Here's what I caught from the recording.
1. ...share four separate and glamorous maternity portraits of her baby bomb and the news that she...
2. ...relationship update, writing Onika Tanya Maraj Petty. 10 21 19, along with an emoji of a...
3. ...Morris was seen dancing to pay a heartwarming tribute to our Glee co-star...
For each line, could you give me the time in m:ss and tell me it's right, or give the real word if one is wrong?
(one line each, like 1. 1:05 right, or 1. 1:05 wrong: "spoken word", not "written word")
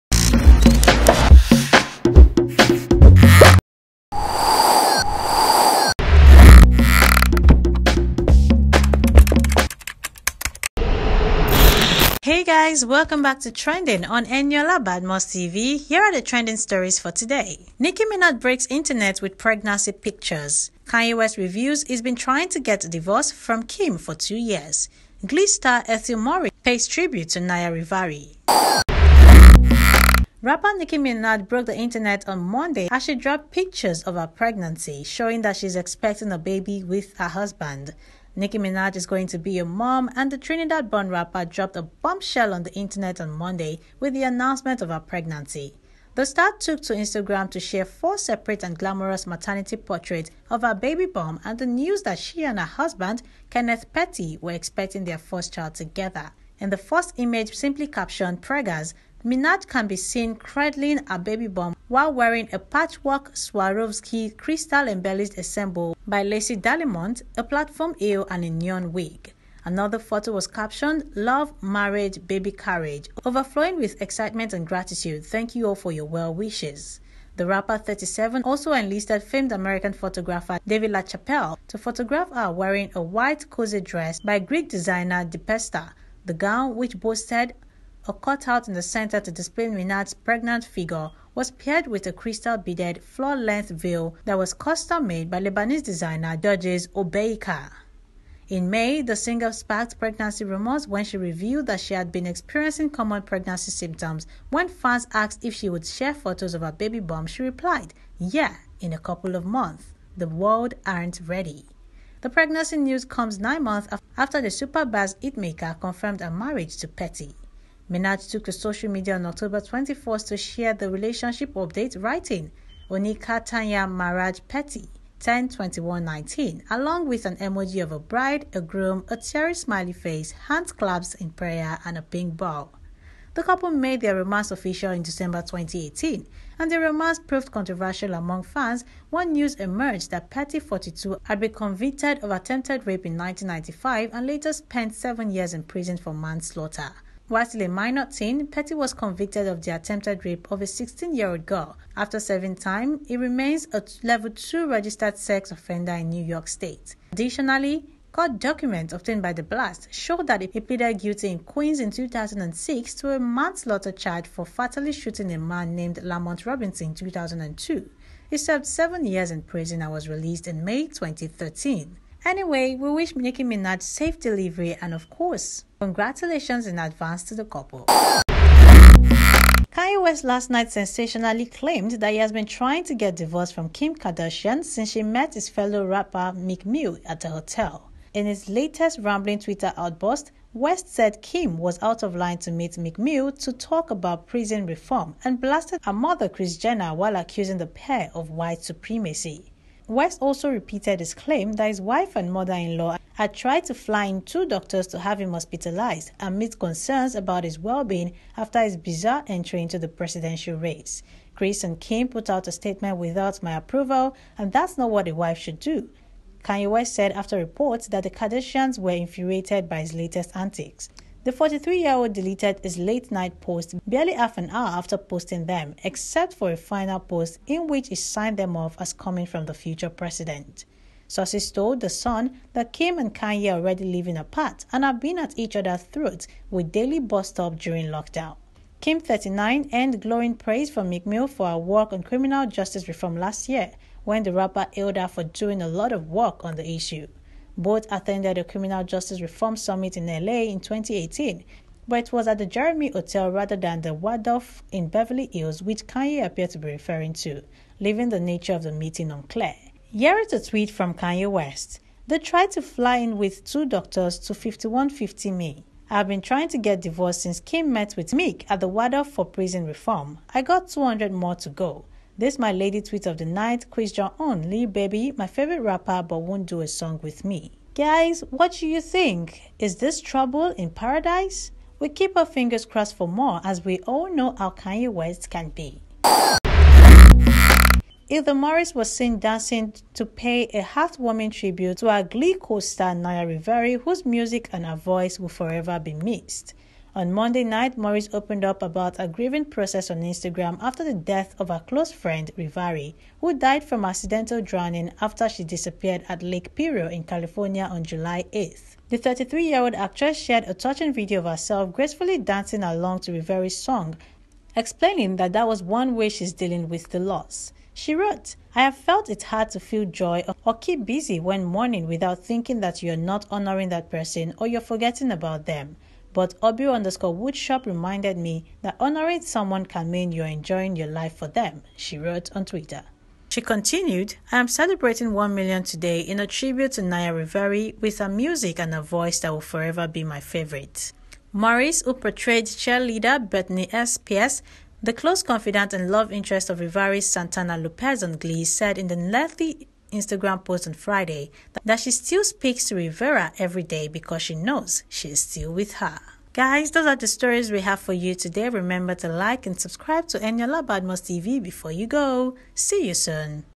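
1. 0:47 right
2. 2:00 right
3. 4:48 right.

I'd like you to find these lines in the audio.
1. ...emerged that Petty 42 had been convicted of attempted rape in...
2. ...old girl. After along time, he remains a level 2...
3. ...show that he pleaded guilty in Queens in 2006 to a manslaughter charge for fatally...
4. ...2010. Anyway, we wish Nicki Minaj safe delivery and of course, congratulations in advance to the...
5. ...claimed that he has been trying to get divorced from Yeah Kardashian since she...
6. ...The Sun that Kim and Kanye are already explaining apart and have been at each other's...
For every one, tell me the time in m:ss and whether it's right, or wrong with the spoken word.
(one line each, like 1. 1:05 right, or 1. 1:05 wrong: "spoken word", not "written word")
1. 2:19 right
2. 2:31 wrong: "serving", not "along"
3. 2:39 right
4. 2:50 wrong: "2013", not "2010"
5. 3:01 wrong: "Kim", not "Yeah"
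6. 3:51 wrong: "living", not "explaining".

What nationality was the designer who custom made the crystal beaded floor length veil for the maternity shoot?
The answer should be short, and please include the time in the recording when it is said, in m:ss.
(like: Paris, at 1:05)
Lebanese, at 1:35.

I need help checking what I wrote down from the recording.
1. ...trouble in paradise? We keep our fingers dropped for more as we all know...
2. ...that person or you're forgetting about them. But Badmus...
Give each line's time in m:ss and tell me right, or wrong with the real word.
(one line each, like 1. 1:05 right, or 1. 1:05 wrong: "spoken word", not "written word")
1. 4:39 wrong: "crossed", not "dropped"
2. 5:23 wrong: "Obi", not "Badmus".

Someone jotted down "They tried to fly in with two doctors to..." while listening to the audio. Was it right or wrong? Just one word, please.
right.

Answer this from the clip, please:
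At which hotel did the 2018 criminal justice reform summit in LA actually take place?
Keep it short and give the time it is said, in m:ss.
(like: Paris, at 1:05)
Jeremy Hotel, at 4:12.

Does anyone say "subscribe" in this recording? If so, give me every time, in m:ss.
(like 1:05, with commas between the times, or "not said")
5:59.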